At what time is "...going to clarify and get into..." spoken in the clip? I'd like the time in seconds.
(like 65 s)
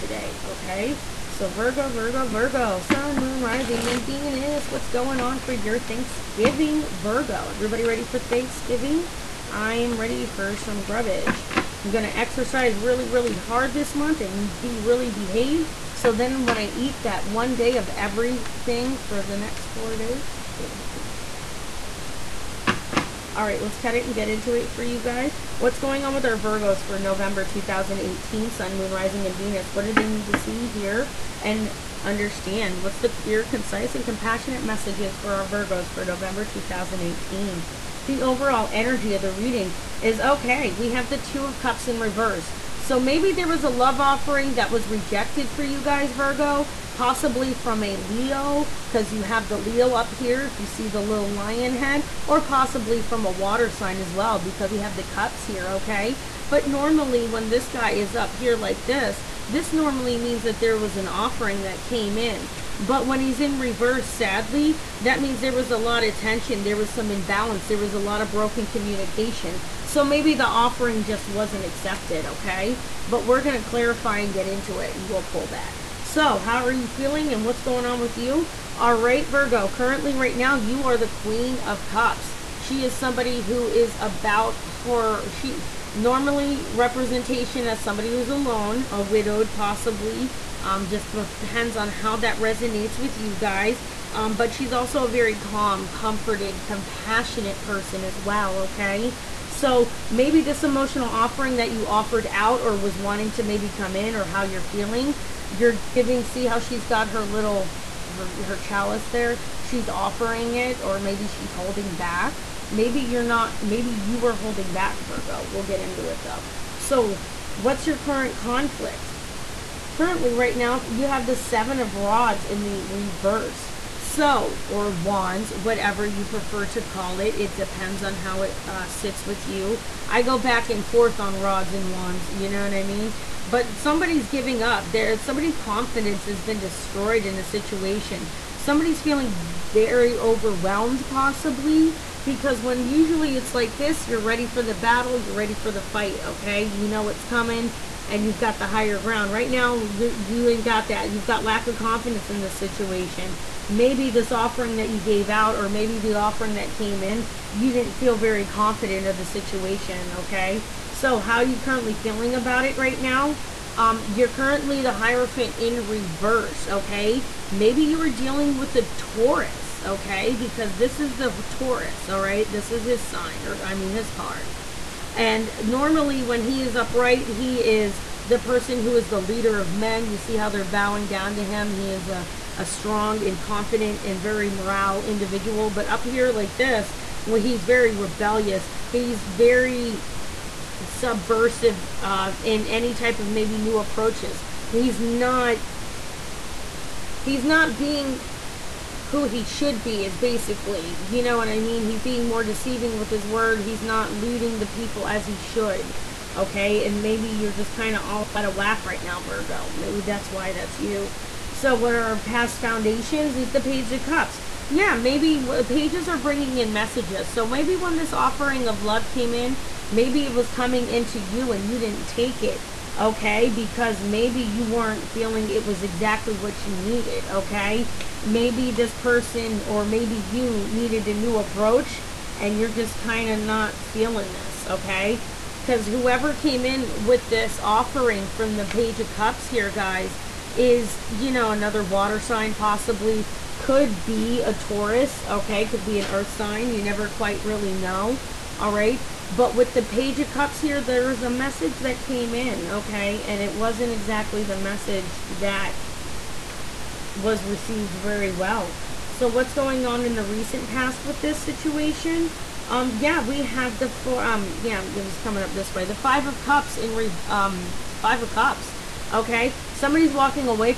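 73 s.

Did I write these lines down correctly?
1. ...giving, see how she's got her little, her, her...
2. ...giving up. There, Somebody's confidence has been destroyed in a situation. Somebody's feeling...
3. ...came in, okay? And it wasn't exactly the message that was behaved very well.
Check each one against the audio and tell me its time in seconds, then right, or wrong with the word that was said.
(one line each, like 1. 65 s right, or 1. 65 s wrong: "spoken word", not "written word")
1. 105 s right
2. 134 s right
3. 252 s wrong: "received", not "behaved".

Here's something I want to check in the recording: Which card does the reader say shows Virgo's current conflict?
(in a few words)
Seven of Rods.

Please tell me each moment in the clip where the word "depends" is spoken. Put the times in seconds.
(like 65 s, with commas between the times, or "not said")
91 s, 127 s.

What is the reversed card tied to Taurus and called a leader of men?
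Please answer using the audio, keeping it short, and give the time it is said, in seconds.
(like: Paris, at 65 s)
Hierophant, at 164 s.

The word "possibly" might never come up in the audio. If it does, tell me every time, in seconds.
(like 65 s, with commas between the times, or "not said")
46 s, 52 s, 89 s, 141 s, 242 s.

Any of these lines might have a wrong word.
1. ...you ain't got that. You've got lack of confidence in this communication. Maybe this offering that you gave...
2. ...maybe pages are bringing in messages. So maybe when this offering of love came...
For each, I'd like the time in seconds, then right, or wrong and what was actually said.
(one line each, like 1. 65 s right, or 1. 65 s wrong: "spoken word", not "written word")
1. 150 s wrong: "situation", not "communication"
2. 215 s right.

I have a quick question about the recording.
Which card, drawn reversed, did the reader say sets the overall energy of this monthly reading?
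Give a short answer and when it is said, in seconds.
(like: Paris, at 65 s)
Two of Cups, at 41 s.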